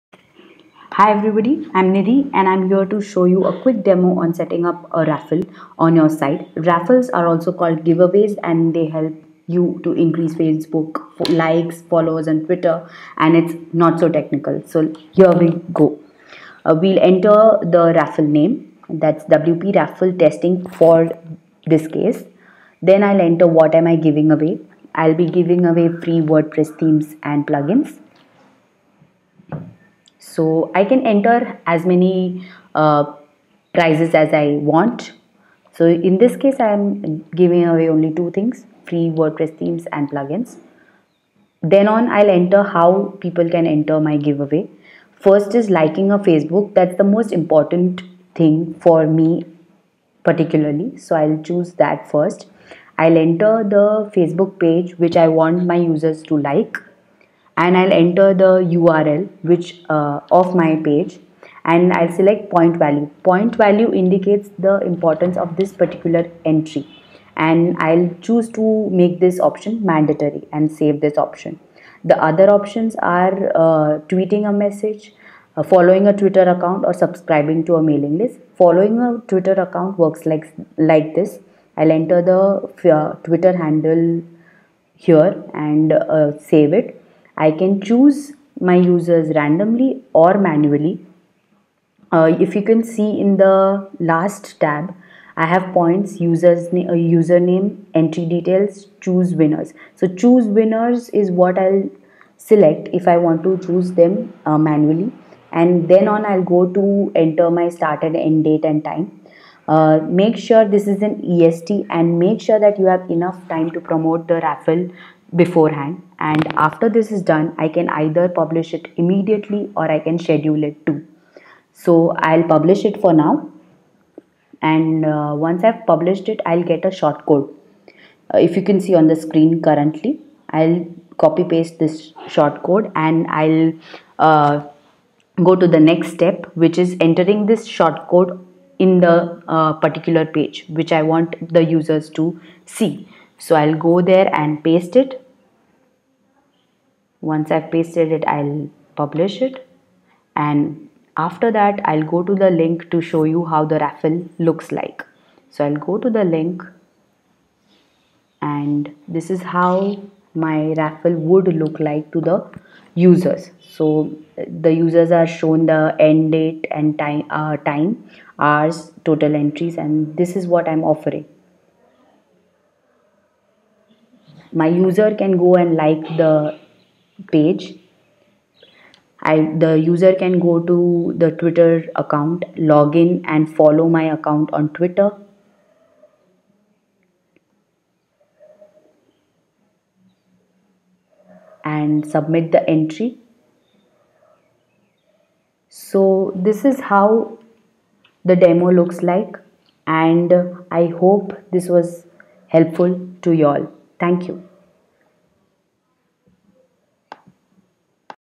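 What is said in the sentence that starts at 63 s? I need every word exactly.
Point value indicates the importance of this particular entry and I'll choose to make this option mandatory and save this option.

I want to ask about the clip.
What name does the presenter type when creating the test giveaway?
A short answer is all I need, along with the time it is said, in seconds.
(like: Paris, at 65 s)
WP raffle testing, at 19 s.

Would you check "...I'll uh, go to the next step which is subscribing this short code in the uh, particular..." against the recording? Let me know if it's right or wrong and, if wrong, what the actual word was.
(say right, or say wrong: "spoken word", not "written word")
wrong: "entering", not "subscribing".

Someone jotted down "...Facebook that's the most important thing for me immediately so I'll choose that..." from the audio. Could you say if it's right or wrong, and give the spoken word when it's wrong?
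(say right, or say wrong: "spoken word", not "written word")
wrong: "particularly", not "immediately".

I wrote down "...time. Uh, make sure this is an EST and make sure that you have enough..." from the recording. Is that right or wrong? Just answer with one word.
right.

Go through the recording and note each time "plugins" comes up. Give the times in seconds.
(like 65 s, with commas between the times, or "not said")
27 s, 40 s.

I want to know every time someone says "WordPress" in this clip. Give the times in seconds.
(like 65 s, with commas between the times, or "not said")
26 s, 39 s.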